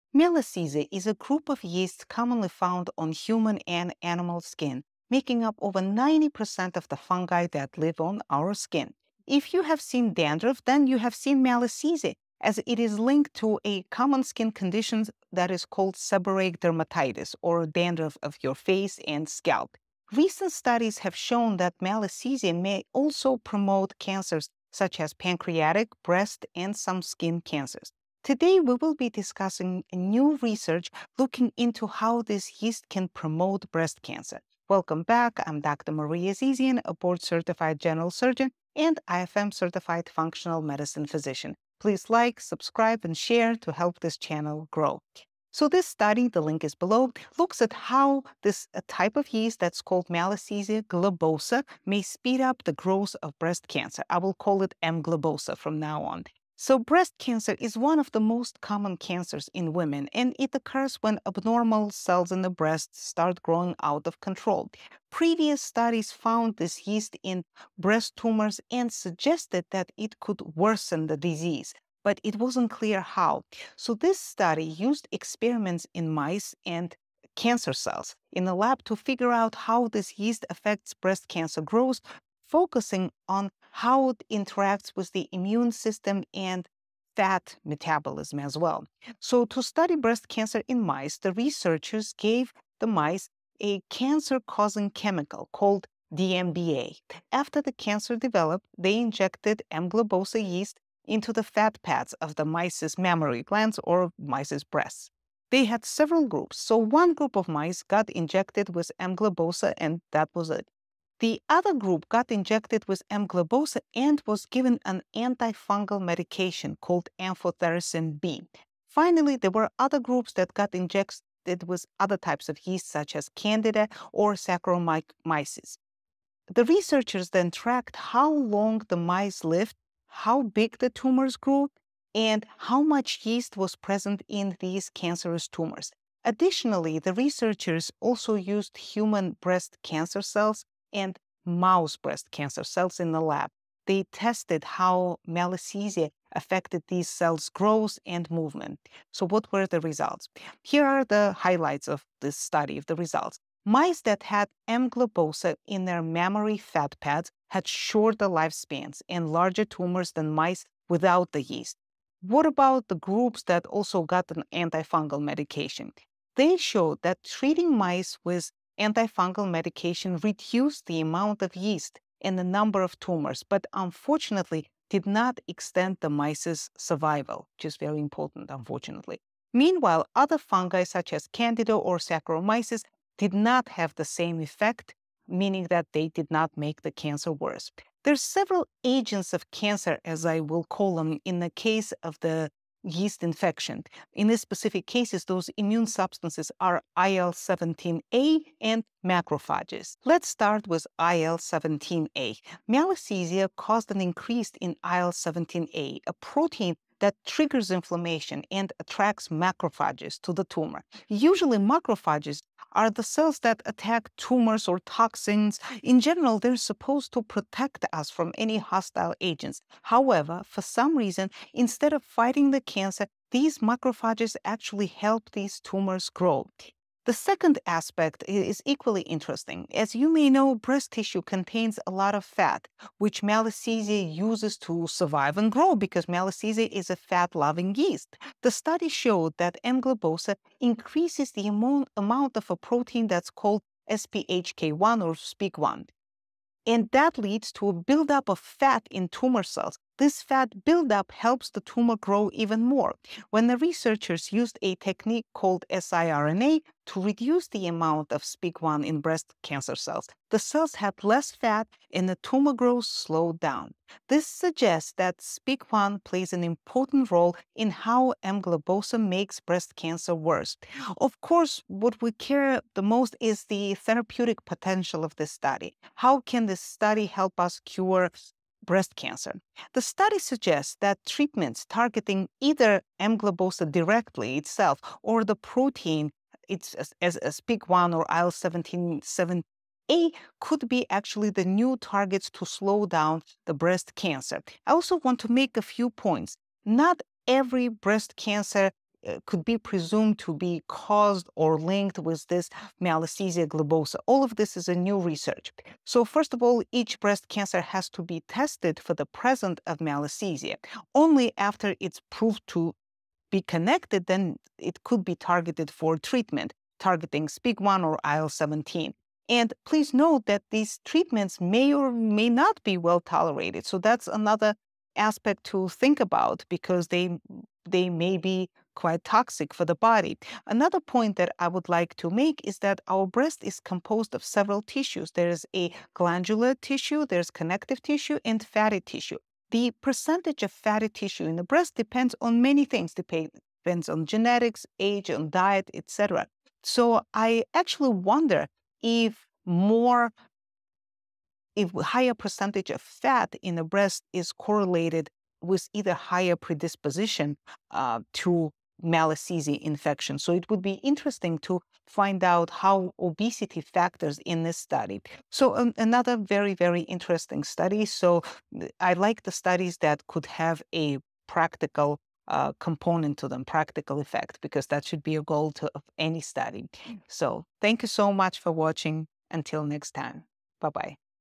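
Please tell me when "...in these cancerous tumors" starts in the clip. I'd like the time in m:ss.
2:14.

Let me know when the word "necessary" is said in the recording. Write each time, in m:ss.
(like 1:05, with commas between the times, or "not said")
not said.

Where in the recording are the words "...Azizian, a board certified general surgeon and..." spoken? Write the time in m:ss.
0:36.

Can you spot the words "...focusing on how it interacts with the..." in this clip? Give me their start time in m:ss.
1:22.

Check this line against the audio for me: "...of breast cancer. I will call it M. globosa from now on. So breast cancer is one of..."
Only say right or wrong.
right.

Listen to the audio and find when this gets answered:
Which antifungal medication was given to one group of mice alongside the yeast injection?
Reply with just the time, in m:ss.
1:57.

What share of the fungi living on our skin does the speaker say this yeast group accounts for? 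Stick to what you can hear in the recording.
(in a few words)
over 90%.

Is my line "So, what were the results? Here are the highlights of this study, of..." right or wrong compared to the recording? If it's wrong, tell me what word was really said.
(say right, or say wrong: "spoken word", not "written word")
right.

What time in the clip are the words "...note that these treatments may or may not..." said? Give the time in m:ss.
5:19.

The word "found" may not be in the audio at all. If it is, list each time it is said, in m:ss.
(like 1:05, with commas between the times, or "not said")
0:02, 1:06.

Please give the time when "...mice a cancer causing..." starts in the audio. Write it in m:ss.
1:32.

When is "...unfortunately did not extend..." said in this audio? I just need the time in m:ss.
2:53.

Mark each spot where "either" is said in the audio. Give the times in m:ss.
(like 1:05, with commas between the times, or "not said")
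4:42, 5:55.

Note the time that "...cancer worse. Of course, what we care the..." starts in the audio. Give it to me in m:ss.
4:29.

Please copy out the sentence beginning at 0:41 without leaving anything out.
Please like, subscribe, and share to help this channel grow.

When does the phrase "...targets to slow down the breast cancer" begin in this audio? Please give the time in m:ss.
4:51.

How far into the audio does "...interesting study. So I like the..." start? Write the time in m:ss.
6:06.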